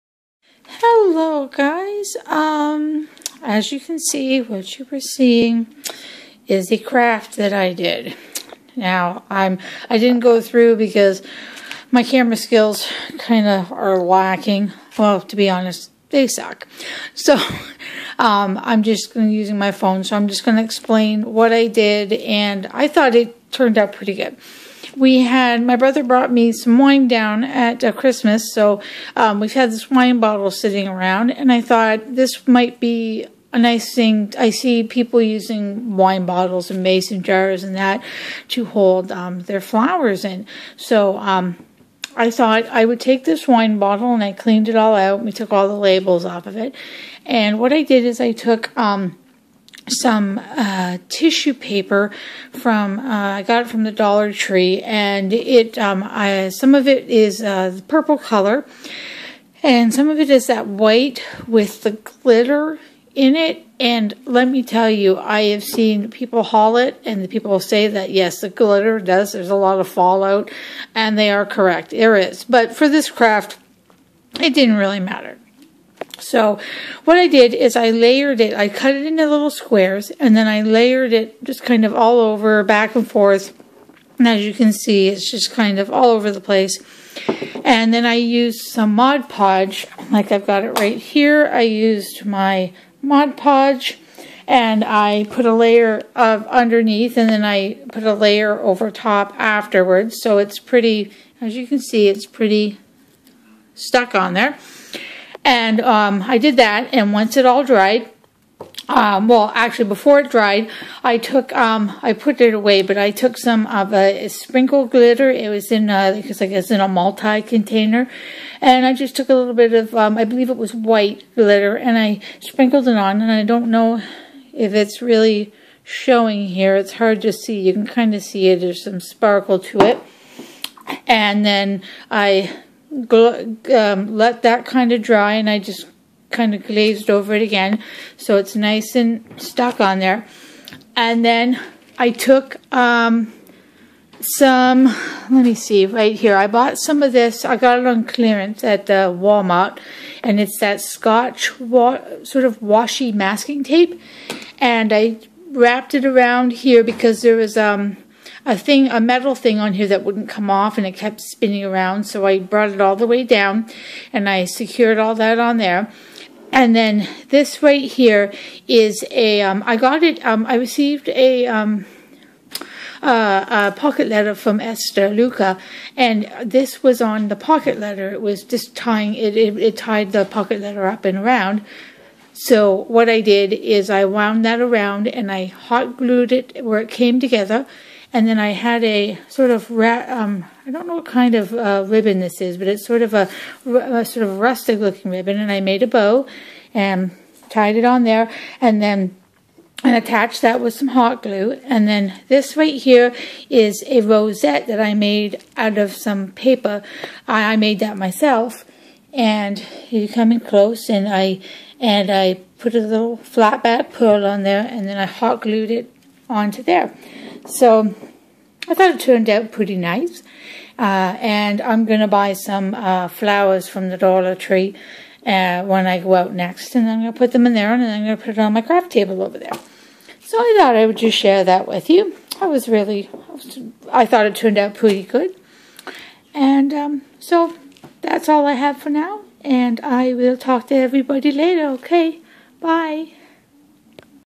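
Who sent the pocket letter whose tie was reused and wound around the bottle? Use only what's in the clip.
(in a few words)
Esther Luca.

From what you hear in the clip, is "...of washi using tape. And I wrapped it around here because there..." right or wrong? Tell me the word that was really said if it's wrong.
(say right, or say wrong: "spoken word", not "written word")
wrong: "masking", not "using".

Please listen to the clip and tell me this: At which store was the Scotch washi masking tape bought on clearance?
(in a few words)
Walmart.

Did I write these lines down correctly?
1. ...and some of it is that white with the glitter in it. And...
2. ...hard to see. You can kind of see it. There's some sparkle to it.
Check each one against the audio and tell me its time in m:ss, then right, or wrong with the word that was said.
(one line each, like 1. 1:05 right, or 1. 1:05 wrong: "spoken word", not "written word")
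1. 0:59 right
2. 2:06 right.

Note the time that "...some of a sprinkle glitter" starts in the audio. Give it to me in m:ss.
1:53.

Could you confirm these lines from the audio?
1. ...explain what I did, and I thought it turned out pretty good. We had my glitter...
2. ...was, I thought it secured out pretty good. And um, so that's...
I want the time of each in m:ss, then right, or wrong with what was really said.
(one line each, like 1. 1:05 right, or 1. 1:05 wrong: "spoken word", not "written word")
1. 0:20 wrong: "brother", not "glitter"
2. 3:53 wrong: "turned", not "secured".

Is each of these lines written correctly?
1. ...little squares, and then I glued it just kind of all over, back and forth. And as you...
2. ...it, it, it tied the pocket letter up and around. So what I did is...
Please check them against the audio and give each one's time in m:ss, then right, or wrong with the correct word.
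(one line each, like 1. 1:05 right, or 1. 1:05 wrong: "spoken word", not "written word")
1. 1:19 wrong: "layered", not "glued"
2. 2:59 right.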